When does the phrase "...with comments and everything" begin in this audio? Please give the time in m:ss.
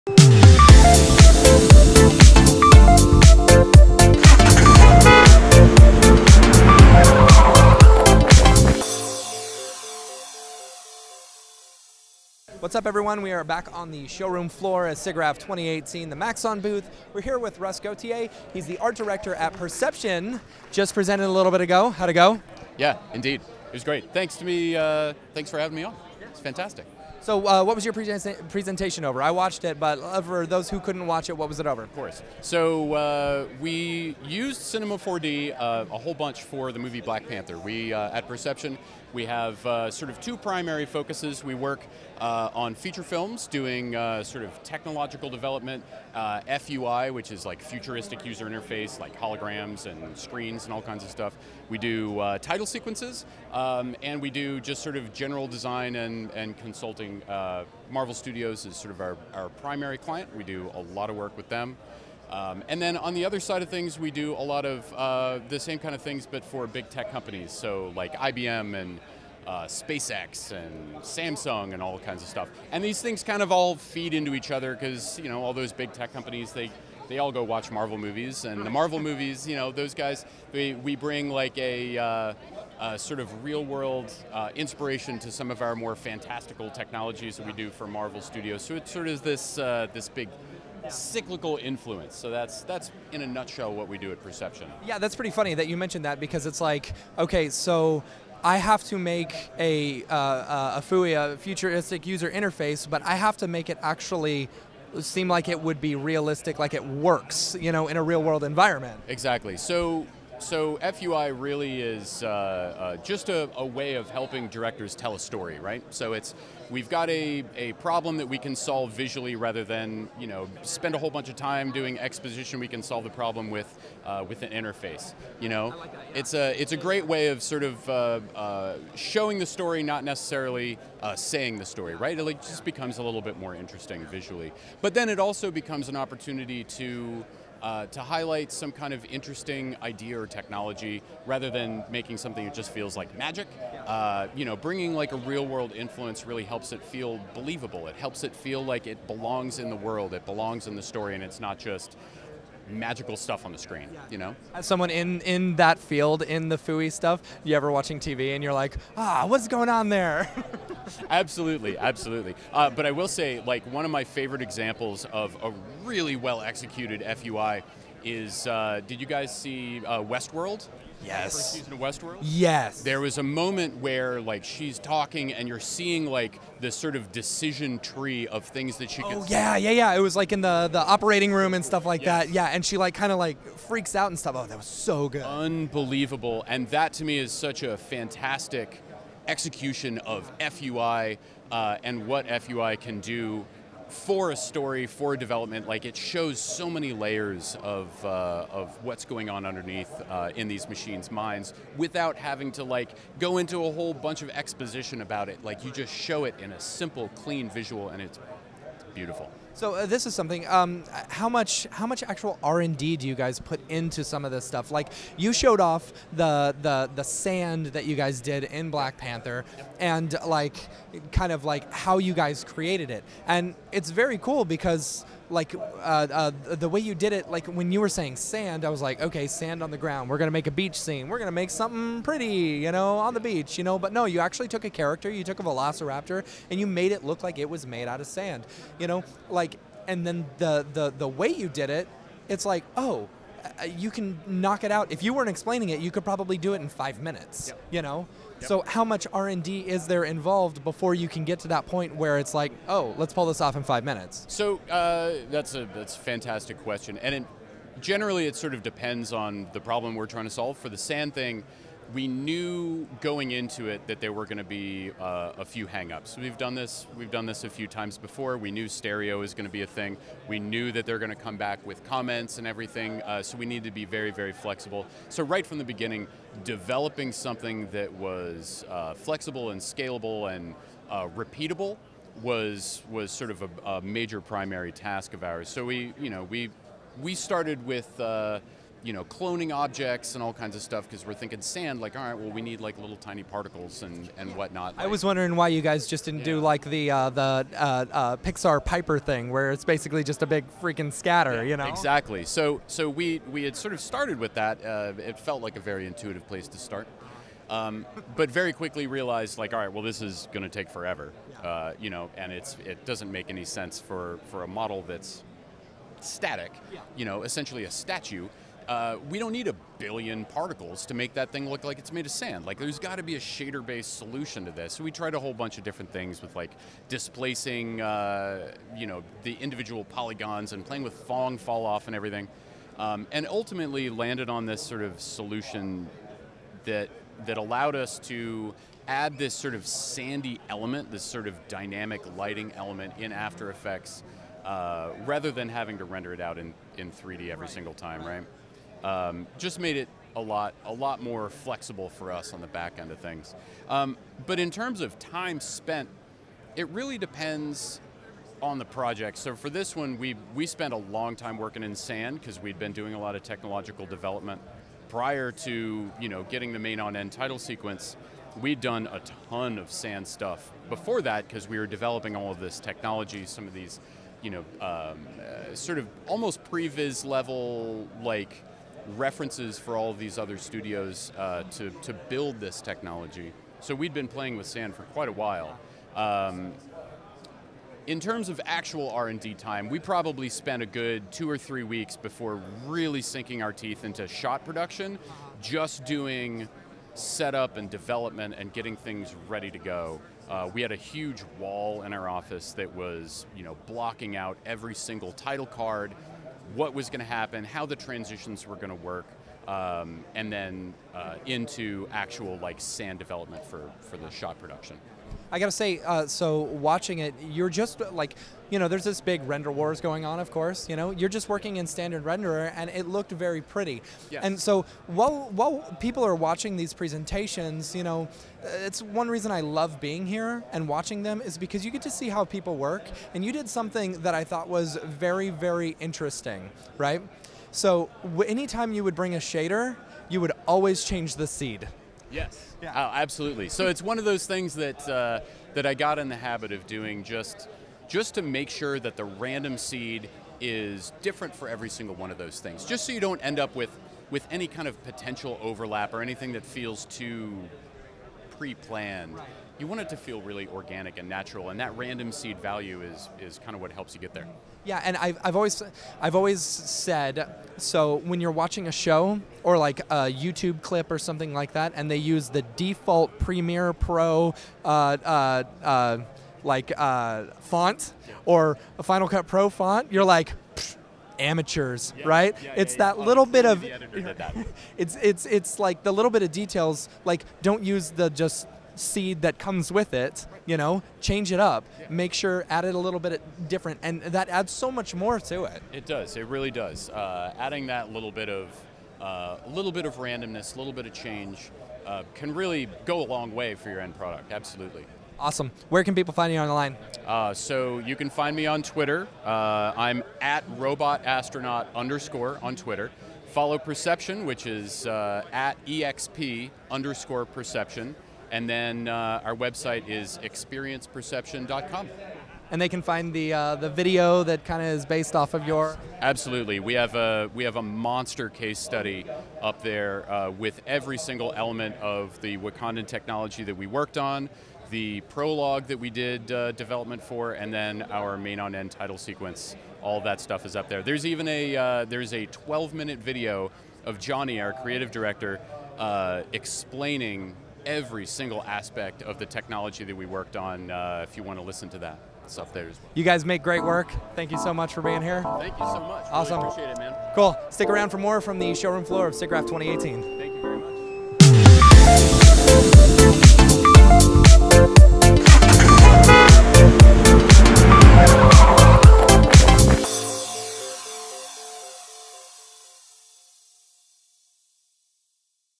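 4:31.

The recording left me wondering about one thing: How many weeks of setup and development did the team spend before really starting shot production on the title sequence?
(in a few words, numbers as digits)
2 or 3 weeks.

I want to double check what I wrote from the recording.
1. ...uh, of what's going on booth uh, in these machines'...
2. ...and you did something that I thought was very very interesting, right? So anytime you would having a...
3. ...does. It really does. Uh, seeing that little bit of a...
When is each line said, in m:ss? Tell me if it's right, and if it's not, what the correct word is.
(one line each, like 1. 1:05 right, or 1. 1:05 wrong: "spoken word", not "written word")
1. 3:18 wrong: "underneath", not "booth"
2. 7:13 wrong: "bring", not "having"
3. 8:15 wrong: "adding", not "seeing".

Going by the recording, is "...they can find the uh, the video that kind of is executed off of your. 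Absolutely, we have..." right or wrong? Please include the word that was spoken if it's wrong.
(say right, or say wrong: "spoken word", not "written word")
wrong: "based", not "executed".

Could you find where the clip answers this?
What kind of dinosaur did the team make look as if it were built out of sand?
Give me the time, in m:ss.
3:55.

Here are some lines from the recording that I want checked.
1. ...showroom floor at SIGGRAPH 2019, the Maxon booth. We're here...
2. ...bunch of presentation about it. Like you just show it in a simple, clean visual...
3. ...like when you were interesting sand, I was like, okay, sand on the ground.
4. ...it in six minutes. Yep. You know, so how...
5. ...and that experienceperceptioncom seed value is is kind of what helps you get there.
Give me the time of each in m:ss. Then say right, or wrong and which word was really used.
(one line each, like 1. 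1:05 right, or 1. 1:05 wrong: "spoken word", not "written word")
1. 0:14 wrong: "2018", not "2019"
2. 3:23 wrong: "exposition", not "presentation"
3. 3:47 wrong: "saying", not "interesting"
4. 4:06 wrong: "five", not "six"
5. 7:41 wrong: "random", not "experienceperceptioncom".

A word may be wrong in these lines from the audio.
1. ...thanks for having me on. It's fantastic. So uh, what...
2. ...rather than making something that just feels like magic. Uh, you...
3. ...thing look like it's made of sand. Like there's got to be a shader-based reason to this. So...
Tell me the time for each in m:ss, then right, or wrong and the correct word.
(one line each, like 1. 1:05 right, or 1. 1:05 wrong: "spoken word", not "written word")
1. 0:25 right
2. 2:21 right
3. 5:21 wrong: "solution", not "reason".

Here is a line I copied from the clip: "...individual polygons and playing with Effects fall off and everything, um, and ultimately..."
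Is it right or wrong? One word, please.
wrong.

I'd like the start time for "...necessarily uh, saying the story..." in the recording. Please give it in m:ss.
2:10.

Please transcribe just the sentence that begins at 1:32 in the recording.
So that's that's in a nutshell what we do at Perception.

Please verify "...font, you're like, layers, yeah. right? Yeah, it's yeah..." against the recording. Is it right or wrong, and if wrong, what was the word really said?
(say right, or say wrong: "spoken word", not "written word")
wrong: "amateurs", not "layers".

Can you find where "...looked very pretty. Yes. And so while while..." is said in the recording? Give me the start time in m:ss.
7:02.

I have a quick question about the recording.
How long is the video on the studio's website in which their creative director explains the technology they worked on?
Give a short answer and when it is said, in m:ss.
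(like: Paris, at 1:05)
12 minutes, at 9:02.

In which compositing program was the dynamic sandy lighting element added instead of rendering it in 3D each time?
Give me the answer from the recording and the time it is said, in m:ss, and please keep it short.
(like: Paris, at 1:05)
After Effects, at 5:43.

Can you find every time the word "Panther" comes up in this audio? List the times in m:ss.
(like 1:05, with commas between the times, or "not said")
0:37, 3:38.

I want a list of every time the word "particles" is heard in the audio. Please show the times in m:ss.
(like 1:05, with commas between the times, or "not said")
4:53, 5:20.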